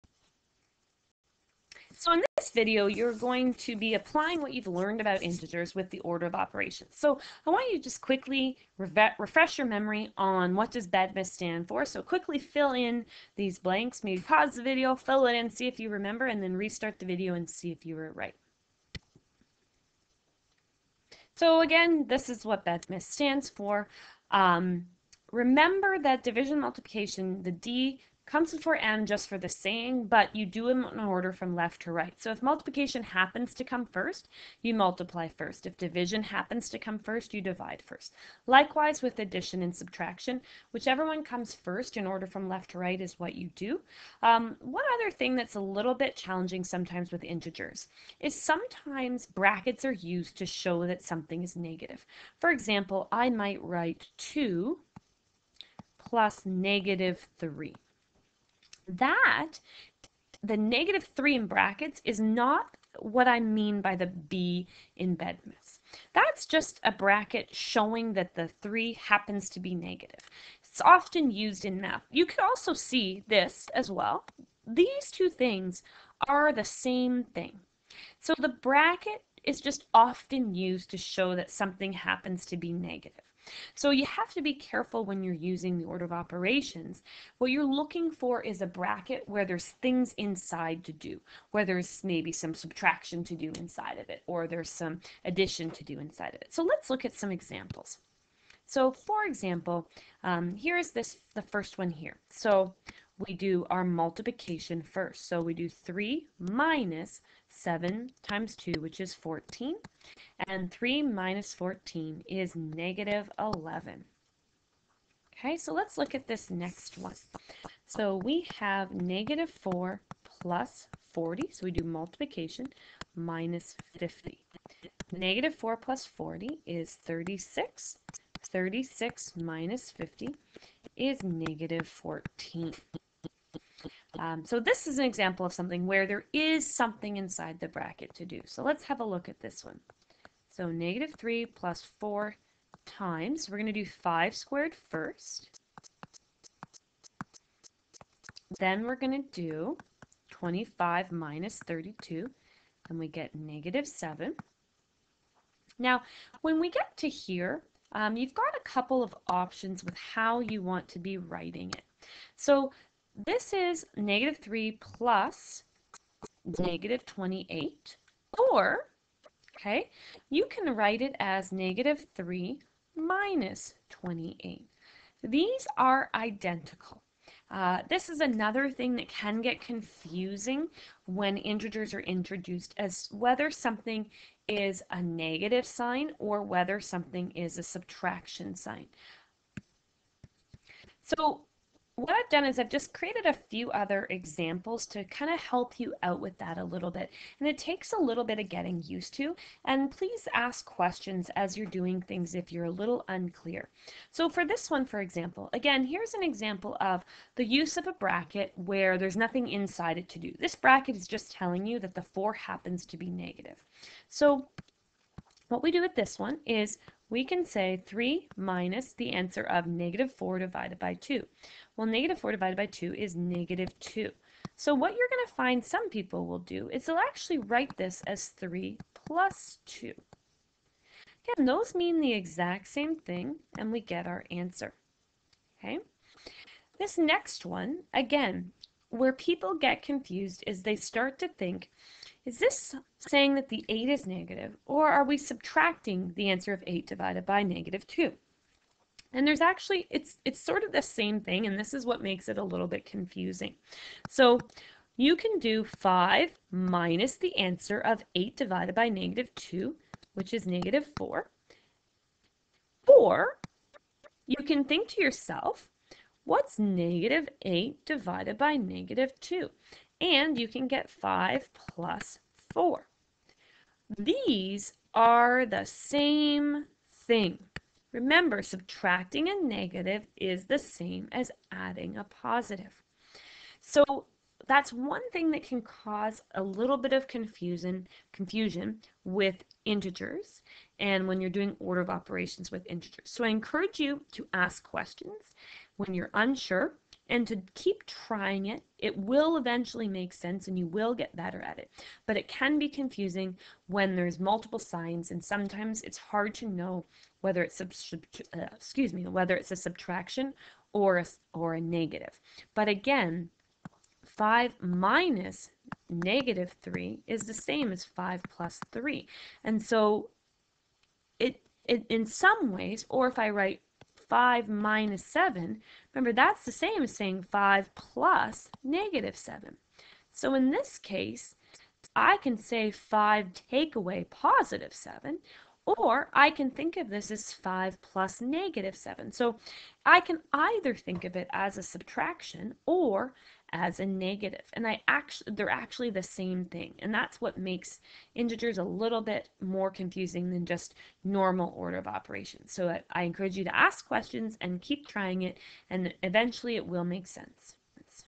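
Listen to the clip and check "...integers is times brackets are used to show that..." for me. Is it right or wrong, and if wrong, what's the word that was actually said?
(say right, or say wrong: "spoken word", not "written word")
wrong: "sometimes", not "times".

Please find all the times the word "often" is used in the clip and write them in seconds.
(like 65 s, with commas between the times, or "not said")
70 s, 79 s.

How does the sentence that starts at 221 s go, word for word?
Well, negative 4 divided by 2 is negative 2.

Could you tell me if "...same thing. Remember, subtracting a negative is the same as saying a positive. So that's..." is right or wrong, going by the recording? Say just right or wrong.
wrong.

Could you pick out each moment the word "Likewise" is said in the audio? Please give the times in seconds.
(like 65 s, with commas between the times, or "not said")
38 s.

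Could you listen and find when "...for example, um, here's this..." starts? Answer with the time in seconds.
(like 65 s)
98 s.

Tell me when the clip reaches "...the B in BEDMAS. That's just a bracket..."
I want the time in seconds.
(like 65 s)
63 s.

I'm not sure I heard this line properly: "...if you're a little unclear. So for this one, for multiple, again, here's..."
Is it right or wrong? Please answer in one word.
wrong.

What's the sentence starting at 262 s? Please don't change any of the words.
Or you can think to yourself, what's negative 8 divided by negative 2?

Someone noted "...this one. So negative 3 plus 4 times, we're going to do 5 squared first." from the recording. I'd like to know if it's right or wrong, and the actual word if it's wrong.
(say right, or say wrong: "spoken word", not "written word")
right.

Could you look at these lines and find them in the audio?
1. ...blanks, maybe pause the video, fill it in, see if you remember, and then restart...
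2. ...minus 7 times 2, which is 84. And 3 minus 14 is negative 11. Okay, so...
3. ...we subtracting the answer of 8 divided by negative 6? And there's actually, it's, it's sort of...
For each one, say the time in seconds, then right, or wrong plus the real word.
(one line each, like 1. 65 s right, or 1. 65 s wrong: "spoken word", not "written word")
1. 13 s right
2. 106 s wrong: "14", not "84"
3. 245 s wrong: "2", not "6".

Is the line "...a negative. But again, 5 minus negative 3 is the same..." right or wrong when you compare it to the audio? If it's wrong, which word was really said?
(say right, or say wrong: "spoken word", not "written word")
right.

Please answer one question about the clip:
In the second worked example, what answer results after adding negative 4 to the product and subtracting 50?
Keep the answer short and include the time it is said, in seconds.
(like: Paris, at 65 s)
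-14, at 131 s.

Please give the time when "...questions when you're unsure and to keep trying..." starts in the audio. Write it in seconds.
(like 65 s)
294 s.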